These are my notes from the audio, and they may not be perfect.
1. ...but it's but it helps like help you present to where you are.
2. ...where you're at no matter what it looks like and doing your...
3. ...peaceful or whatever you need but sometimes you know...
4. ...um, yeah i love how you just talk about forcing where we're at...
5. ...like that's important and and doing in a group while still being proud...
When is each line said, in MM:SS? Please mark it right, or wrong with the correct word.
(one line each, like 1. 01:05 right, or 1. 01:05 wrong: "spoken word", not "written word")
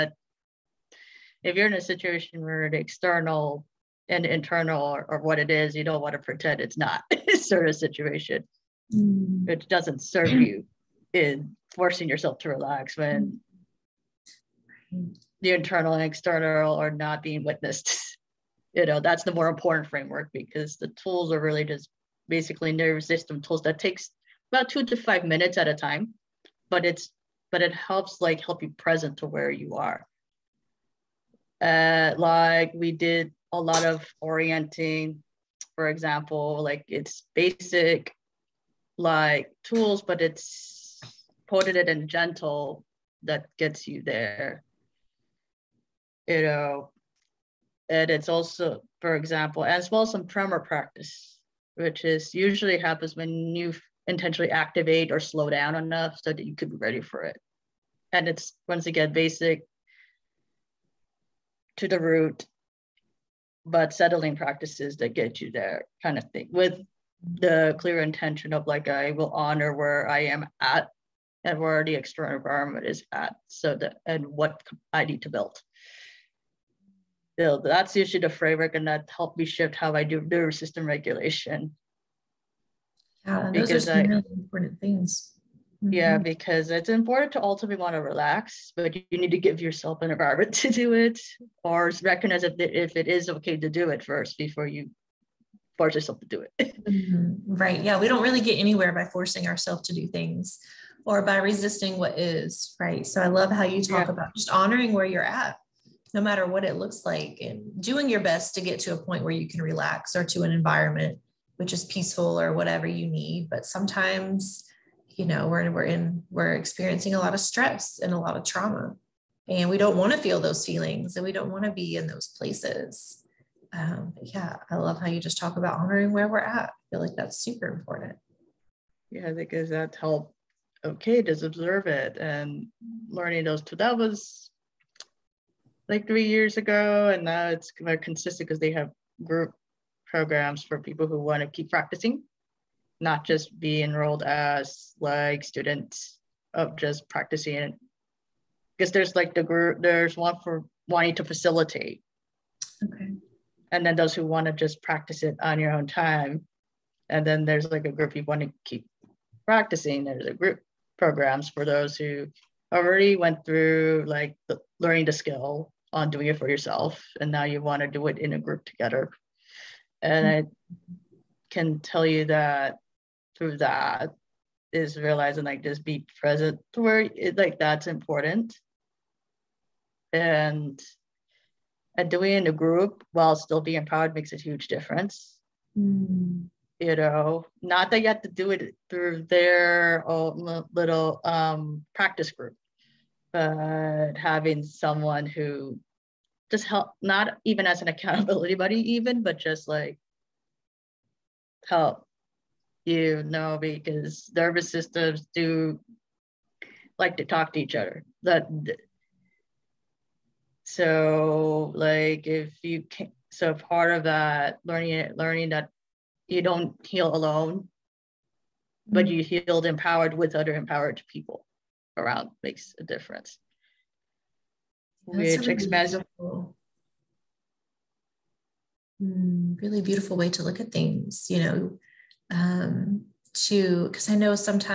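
1. 00:26 right
2. 01:44 right
3. 01:51 right
4. 02:03 wrong: "honoring", not "forcing"
5. 02:57 right.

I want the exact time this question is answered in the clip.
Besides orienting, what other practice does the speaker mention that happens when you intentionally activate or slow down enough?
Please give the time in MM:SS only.
00:50.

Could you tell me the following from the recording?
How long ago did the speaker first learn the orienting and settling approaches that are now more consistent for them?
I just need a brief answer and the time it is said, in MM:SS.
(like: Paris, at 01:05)
3 years ago, at 02:16.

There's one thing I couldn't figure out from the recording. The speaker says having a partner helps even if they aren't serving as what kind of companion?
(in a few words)
accountability buddy.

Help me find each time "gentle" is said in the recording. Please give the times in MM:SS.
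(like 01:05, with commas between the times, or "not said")
00:42.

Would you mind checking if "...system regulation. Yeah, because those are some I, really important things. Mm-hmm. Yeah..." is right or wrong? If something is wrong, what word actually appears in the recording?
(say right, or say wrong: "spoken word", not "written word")
right.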